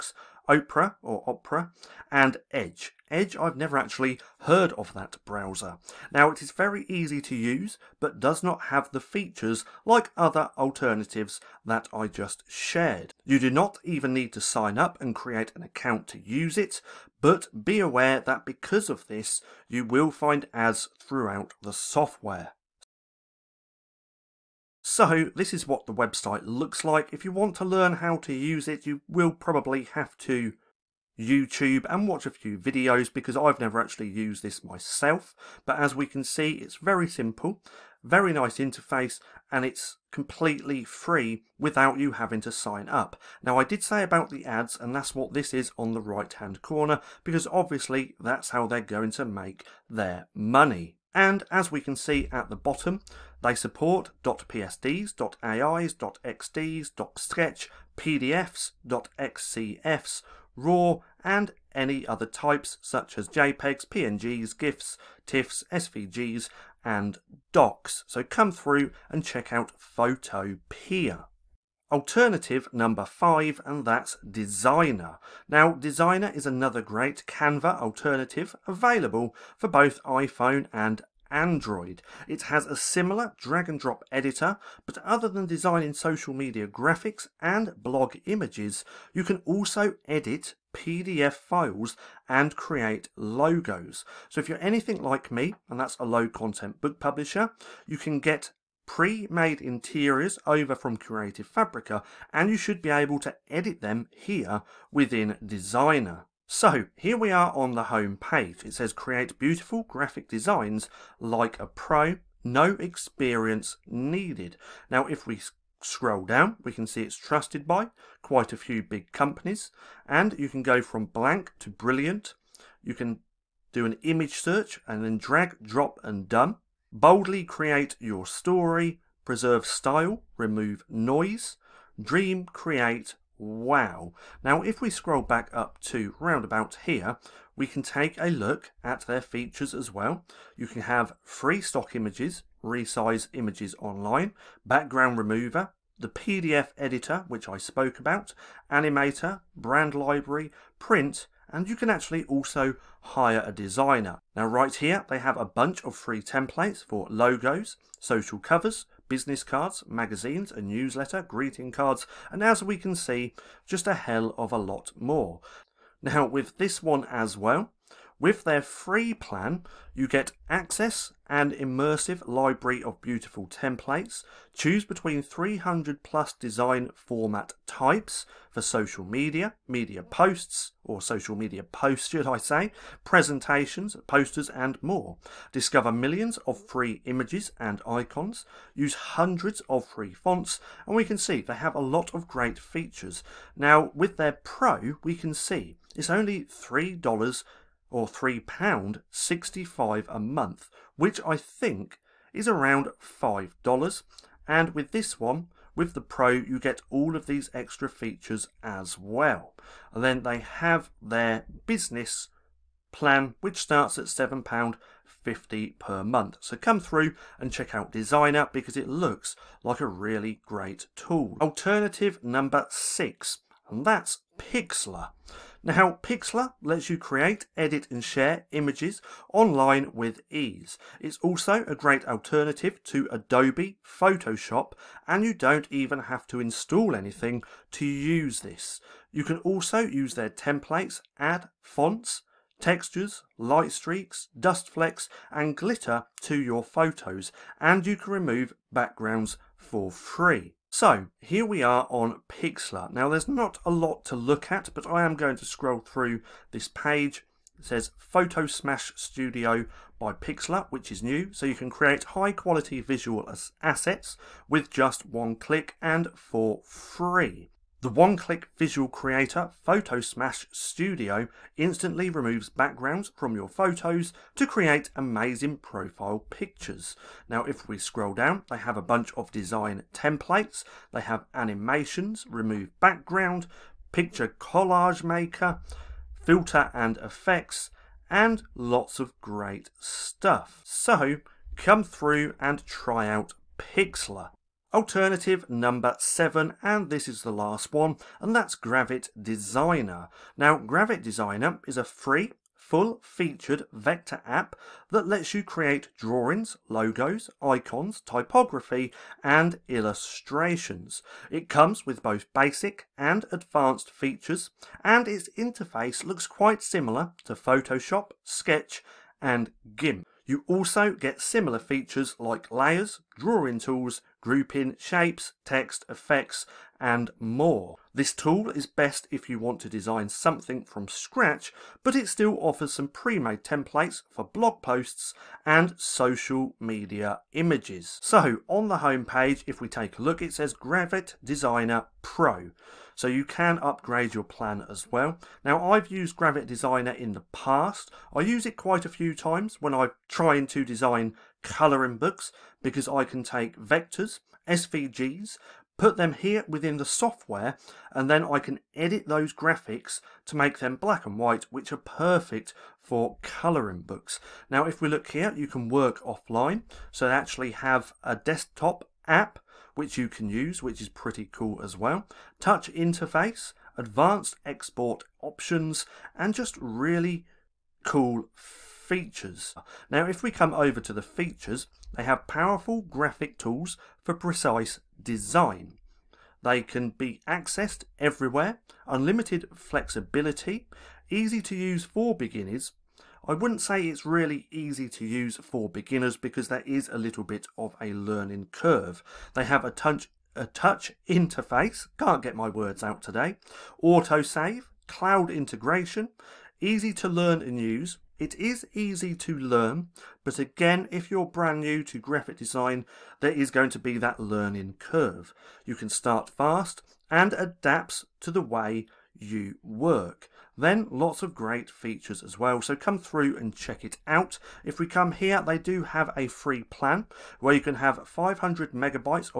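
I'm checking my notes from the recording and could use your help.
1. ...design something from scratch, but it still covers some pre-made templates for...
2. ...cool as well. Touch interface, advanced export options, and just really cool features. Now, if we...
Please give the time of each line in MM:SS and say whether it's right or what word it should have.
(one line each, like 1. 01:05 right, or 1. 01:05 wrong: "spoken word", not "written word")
1. 05:29 wrong: "offers", not "covers"
2. 06:11 right.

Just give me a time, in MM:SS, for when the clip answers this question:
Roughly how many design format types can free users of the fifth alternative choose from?
02:55.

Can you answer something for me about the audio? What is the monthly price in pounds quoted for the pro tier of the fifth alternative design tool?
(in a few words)
£3.65.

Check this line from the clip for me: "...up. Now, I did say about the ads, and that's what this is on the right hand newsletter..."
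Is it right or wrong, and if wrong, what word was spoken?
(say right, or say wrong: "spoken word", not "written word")
wrong: "corner", not "newsletter".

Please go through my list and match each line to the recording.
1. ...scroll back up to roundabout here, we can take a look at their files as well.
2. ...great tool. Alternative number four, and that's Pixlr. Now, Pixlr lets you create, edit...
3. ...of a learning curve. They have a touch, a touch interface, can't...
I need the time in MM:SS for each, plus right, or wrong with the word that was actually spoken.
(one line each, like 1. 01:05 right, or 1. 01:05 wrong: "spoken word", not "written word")
1. 02:14 wrong: "features", not "files"
2. 03:40 wrong: "six", not "four"
3. 06:37 right.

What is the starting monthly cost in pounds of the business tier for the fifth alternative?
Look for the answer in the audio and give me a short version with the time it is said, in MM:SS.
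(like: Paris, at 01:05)
£7.50, at 03:34.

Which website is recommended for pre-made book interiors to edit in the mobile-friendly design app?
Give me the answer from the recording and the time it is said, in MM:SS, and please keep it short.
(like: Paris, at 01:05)
Creative Fabrica, at 01:40.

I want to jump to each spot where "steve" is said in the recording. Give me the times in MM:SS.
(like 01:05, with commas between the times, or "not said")
not said.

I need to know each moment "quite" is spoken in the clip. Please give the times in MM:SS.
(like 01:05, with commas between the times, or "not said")
01:58, 05:16, 05:48.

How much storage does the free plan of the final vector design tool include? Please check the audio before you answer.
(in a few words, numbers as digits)
500 megabytes.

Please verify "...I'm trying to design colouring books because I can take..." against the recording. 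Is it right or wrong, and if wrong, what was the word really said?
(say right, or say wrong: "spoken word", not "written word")
right.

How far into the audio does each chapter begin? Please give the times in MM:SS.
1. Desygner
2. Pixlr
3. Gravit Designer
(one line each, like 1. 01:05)
1. 01:10
2. 03:39
3. 04:53.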